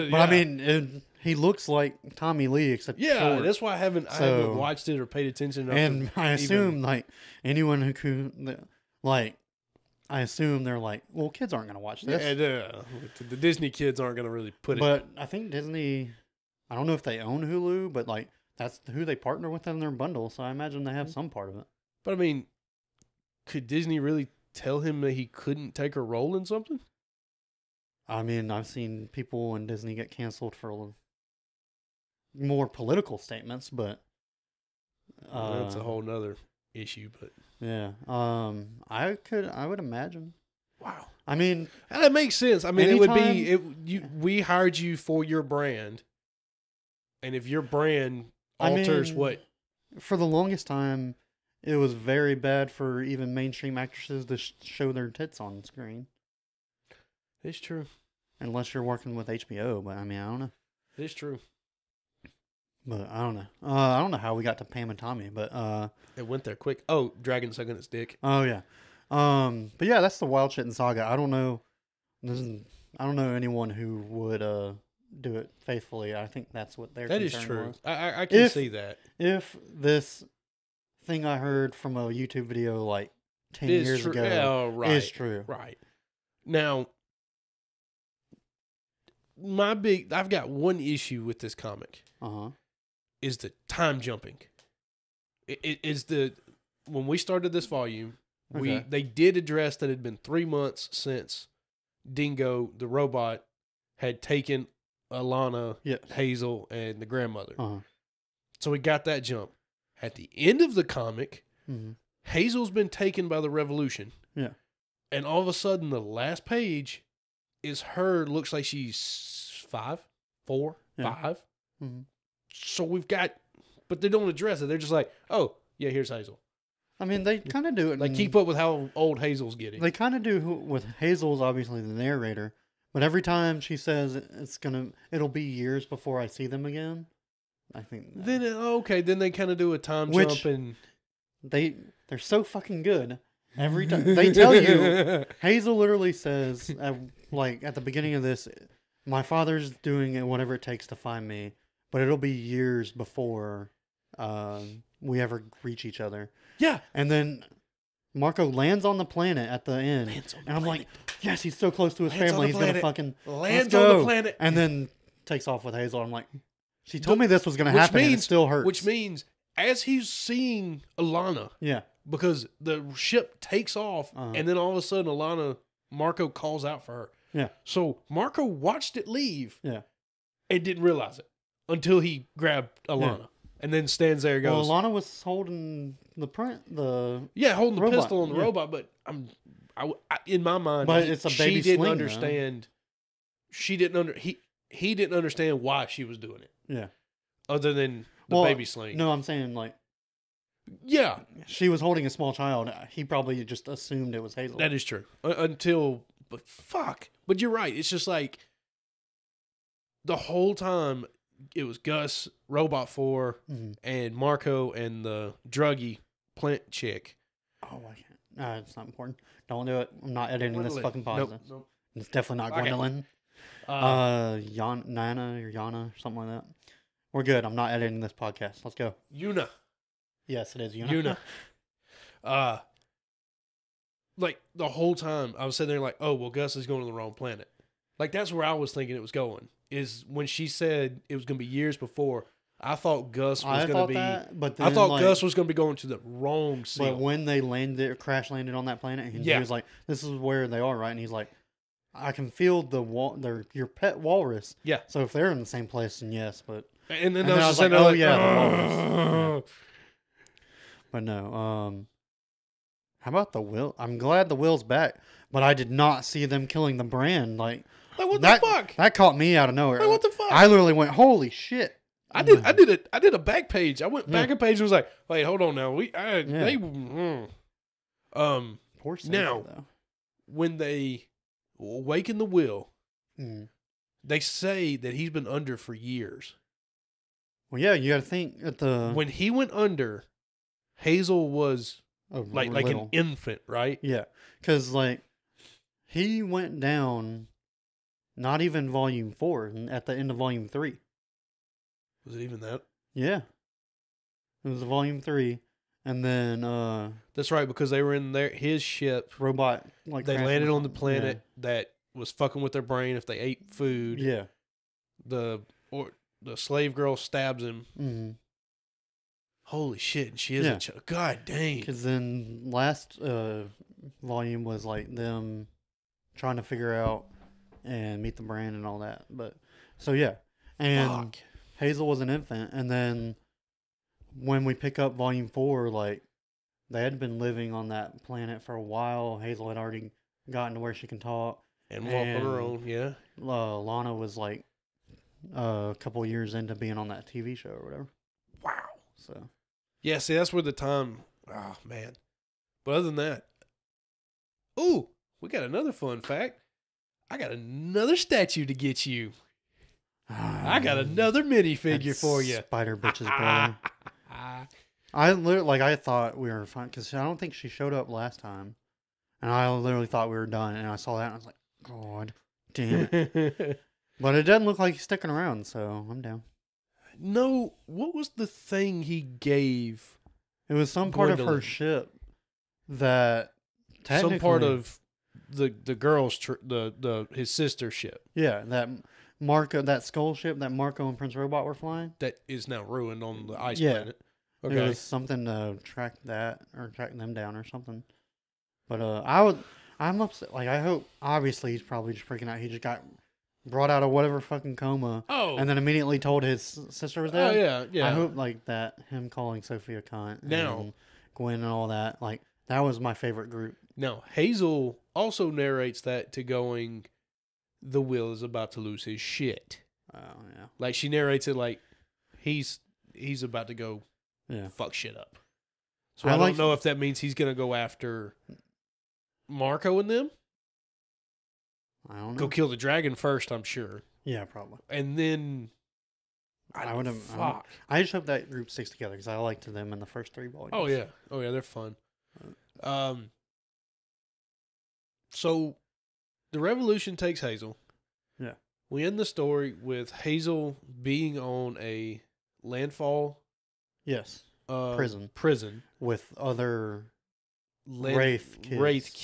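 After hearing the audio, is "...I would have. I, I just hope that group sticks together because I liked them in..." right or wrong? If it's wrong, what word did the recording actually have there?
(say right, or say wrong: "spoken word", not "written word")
right.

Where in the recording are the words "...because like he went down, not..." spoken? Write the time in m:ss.
4:54.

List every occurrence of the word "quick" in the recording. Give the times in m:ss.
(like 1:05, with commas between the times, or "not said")
1:06.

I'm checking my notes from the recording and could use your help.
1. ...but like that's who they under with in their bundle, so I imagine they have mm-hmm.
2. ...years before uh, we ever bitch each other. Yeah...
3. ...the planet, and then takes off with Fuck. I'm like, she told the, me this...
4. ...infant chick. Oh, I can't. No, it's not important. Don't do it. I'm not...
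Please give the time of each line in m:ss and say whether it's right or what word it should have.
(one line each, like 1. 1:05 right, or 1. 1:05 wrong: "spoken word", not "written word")
1. 0:17 wrong: "partner", not "under"
2. 2:32 wrong: "reach", not "bitch"
3. 2:43 wrong: "Hazel", not "Fuck"
4. 3:36 wrong: "plant", not "infant".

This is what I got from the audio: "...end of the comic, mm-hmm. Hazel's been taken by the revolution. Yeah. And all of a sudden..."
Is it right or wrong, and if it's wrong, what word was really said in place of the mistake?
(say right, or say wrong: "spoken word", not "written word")
right.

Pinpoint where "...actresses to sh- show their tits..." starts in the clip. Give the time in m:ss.
0:53.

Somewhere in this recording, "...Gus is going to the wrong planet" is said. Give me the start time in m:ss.
3:56.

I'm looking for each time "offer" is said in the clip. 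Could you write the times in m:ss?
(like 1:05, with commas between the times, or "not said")
not said.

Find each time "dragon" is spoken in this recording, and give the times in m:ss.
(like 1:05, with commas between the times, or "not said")
1:07, 7:12.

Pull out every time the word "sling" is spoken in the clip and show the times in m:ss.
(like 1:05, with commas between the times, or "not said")
3:11, 3:18.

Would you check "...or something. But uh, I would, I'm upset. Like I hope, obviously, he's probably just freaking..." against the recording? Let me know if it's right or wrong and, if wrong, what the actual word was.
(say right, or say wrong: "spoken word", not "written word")
right.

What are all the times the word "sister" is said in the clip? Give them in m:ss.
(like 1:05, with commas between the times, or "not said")
6:27, 6:46.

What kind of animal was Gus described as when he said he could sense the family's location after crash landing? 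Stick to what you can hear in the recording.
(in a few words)
walrus.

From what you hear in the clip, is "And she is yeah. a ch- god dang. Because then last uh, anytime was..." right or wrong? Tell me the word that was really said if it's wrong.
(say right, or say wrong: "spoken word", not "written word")
wrong: "volume", not "anytime".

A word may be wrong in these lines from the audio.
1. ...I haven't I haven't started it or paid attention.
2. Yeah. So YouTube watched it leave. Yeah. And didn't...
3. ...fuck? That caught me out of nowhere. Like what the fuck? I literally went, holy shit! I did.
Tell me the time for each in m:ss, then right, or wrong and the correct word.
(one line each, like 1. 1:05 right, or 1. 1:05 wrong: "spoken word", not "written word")
1. 0:03 wrong: "watched", not "started"
2. 2:57 wrong: "Marco", not "YouTube"
3. 4:28 right.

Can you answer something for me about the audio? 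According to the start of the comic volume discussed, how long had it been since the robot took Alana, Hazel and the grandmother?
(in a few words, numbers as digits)
3 months.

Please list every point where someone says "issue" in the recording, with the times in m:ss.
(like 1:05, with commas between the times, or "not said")
0:36, 1:30.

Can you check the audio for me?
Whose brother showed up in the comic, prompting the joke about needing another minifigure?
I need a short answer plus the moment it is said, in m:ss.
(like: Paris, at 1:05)
Spider bitch, at 6:02.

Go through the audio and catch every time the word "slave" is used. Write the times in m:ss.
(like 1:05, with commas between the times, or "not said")
5:16.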